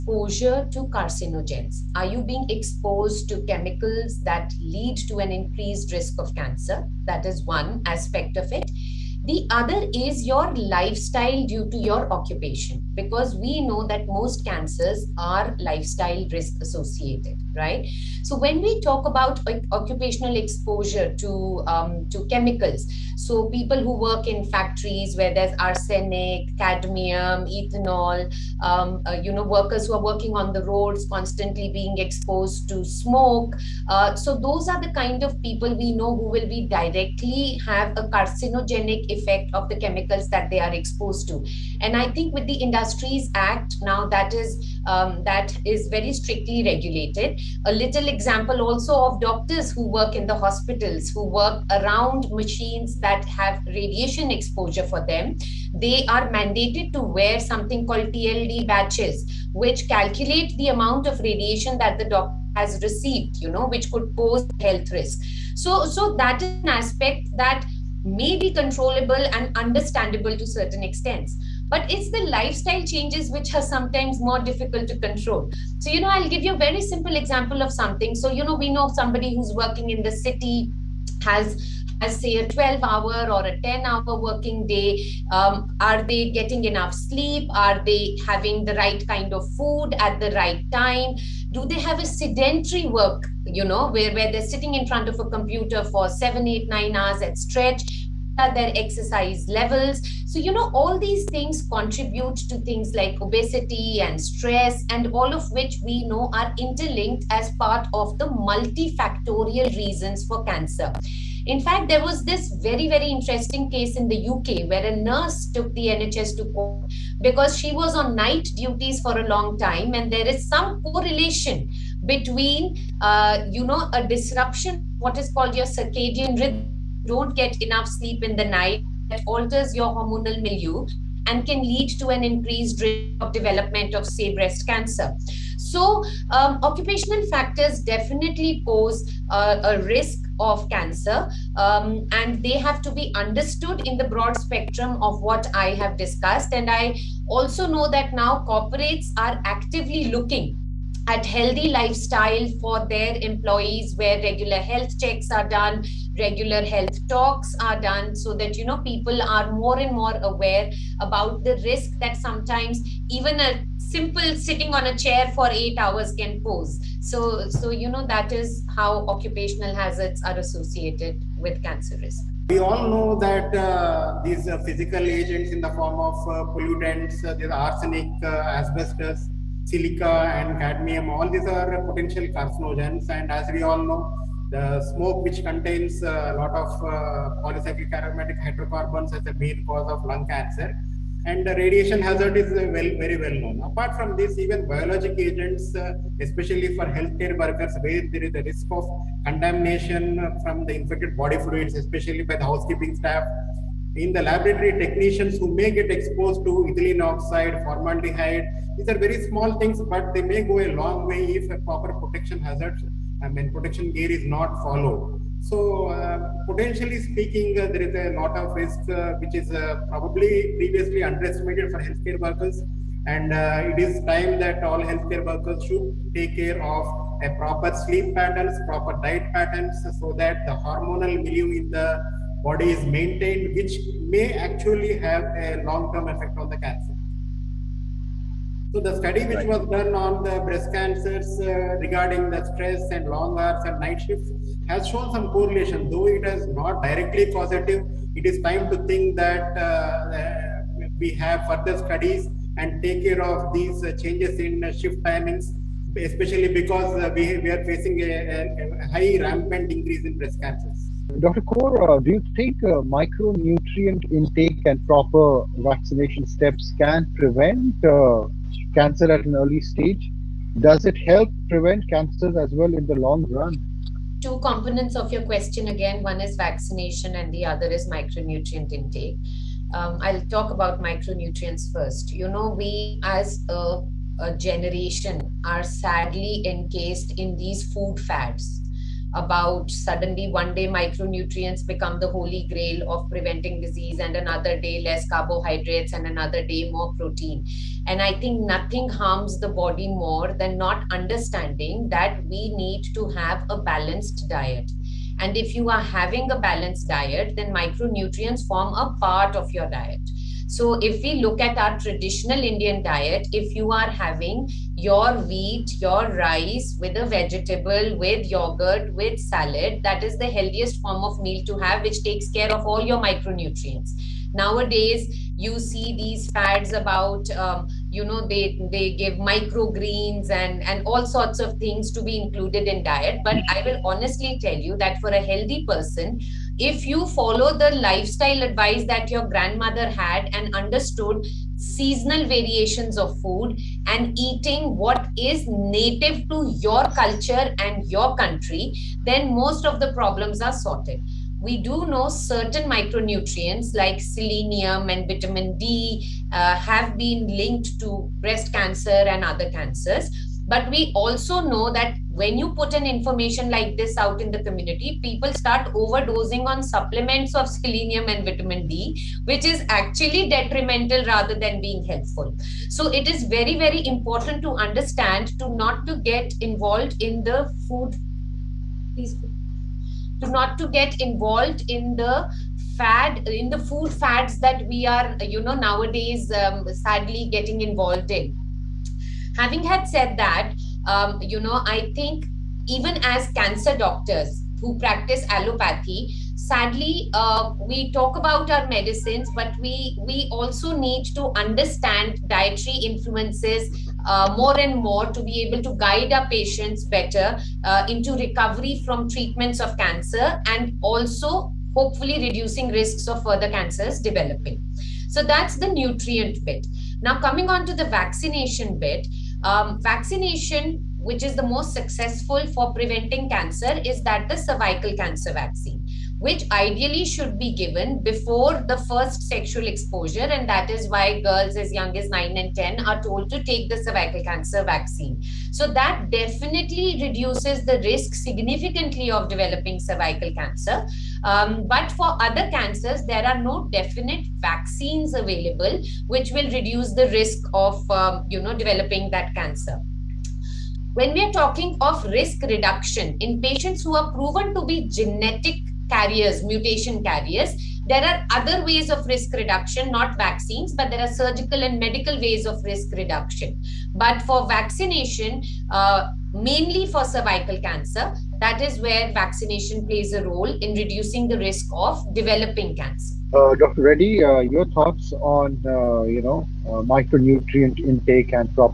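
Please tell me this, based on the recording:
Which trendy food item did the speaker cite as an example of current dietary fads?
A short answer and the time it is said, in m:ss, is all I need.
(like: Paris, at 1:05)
microgreens, at 5:29.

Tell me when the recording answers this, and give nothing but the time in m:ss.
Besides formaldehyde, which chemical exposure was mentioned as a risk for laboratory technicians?
3:26.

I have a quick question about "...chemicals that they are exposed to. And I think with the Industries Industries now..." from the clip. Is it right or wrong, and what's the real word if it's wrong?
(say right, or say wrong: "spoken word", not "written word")
wrong: "Act", not "Industries".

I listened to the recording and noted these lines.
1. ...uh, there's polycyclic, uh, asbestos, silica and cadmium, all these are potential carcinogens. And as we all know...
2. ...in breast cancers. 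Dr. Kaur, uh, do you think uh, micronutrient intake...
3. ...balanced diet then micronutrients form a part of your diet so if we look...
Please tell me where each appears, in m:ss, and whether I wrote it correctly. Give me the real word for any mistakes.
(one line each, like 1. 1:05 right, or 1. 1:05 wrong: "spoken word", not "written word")
1. 2:57 wrong: "arsenic", not "polycyclic"
2. 4:20 right
3. 5:06 right.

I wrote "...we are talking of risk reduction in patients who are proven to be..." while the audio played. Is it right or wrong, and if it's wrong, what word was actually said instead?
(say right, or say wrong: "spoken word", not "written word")
right.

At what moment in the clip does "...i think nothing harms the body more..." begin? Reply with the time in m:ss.
4:58.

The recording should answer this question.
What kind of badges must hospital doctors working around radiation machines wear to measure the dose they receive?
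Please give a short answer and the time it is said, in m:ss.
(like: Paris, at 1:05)
TLD badges, at 0:58.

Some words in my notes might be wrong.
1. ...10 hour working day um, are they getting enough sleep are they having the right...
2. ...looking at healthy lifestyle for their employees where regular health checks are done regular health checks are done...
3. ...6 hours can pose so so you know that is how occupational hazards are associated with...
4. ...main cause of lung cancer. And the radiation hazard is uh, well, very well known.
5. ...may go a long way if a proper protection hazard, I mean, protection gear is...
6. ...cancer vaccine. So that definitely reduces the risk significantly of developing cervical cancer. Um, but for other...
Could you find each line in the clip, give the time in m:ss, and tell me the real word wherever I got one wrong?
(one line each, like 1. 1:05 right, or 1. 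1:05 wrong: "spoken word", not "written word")
1. 1:23 right
2. 2:30 wrong: "talks", not "checks"
3. 2:45 wrong: "8", not "6"
4. 3:09 right
5. 3:30 right
6. 7:14 right.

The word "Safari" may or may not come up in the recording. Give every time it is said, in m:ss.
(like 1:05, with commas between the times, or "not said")
not said.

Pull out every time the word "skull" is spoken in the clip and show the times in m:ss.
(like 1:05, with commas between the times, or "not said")
not said.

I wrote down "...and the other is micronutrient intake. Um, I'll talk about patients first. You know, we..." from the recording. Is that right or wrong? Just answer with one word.
wrong.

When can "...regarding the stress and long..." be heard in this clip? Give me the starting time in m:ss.
4:01.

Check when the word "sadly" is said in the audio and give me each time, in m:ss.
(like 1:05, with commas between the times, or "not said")
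4:45, 6:26, 6:36.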